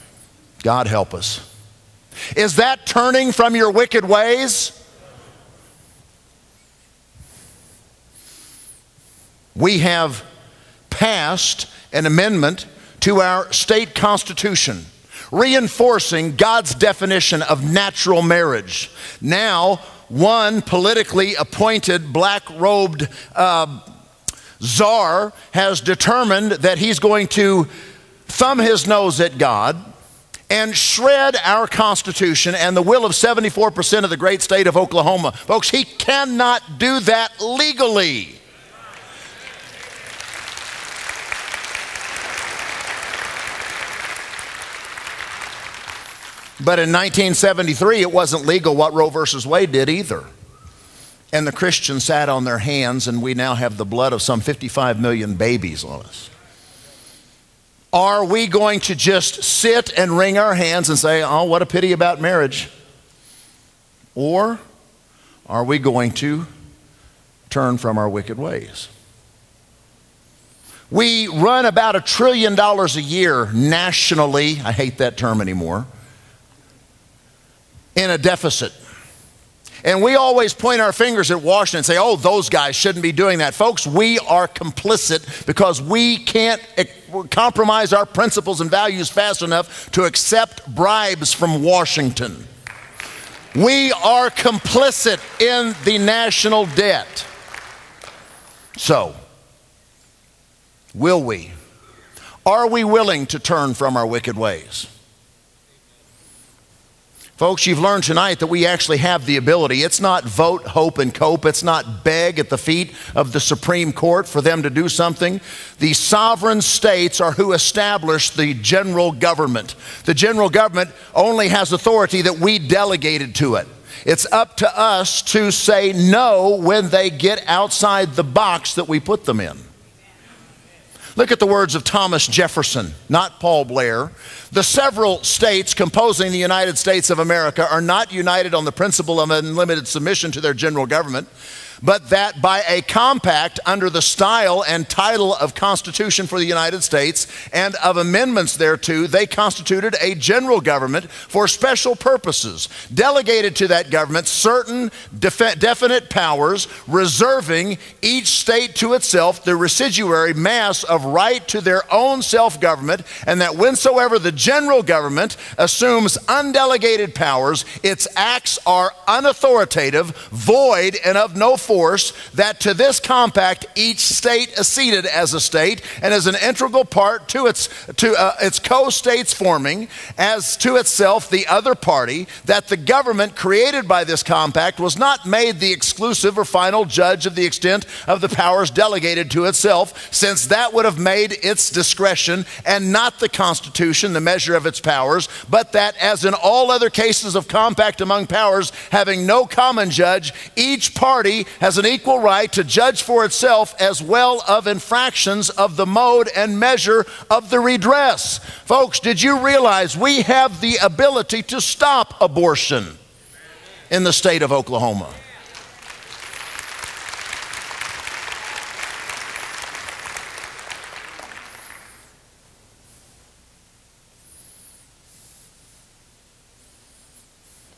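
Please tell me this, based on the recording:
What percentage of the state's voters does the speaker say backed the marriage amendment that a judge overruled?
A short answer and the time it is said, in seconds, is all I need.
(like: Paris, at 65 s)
74%, at 33 s.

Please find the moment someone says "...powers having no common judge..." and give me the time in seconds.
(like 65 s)
198 s.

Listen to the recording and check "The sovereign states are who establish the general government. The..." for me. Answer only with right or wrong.
right.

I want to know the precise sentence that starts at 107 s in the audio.
Folks, you've learned tonight that we actually have the ability.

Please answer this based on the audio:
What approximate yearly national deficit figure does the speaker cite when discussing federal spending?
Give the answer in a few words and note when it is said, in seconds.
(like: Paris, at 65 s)
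a trillion dollars, at 71 s.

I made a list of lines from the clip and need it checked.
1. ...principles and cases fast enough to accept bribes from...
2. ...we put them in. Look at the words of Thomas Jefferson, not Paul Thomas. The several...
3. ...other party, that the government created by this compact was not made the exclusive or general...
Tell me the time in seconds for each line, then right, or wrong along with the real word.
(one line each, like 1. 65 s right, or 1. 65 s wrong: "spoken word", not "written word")
1. 88 s wrong: "values", not "cases"
2. 128 s wrong: "Blair", not "Thomas"
3. 181 s wrong: "final", not "general".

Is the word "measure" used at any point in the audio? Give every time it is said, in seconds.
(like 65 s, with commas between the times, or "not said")
194 s, 206 s.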